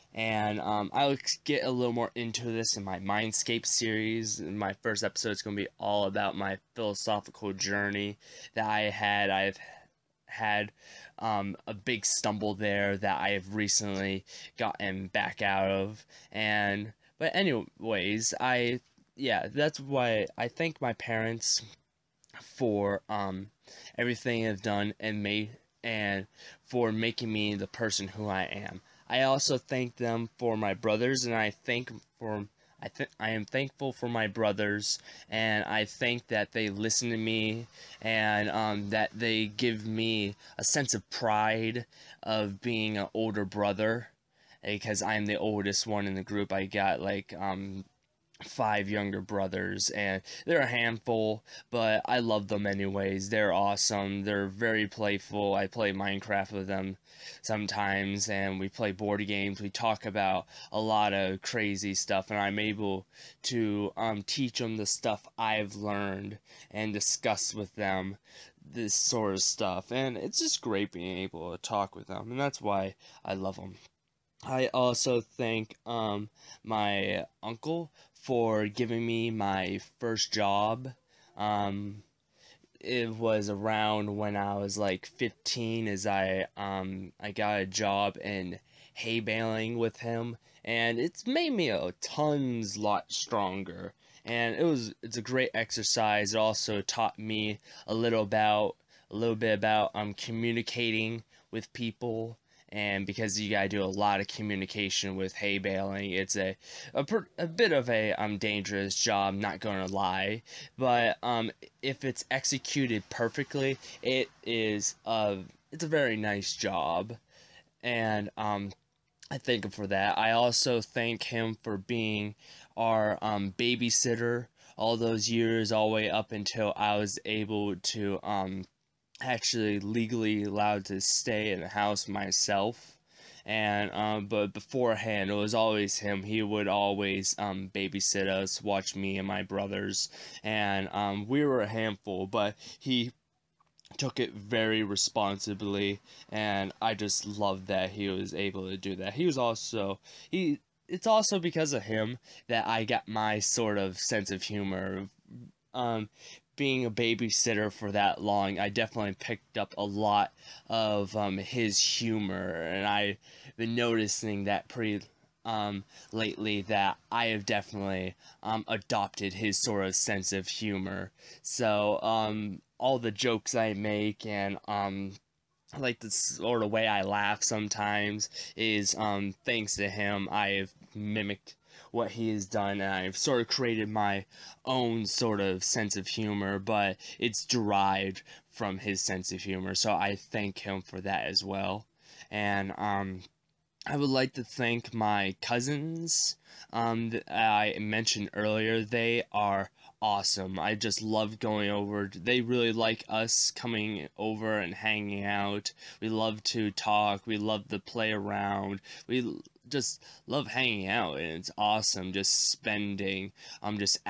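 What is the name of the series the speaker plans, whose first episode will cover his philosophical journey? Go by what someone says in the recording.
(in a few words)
Mindscape.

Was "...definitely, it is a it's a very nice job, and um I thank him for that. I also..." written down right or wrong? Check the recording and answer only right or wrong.
wrong.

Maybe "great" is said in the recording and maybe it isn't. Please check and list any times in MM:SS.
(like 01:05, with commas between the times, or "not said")
01:10, 01:35.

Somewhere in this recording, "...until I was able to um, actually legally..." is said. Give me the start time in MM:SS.
02:06.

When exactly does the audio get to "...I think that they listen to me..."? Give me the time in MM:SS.
00:35.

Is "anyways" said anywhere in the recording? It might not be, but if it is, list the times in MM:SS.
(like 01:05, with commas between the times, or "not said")
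00:17, 00:52.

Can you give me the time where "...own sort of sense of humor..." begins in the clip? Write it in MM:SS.
03:04.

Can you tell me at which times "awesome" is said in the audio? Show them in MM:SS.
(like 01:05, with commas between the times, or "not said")
00:53, 03:20, 03:31.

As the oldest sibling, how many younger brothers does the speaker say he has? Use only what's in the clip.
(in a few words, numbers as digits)
5.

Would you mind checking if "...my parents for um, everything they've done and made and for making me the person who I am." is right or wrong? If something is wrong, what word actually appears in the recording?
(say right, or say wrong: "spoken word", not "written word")
right.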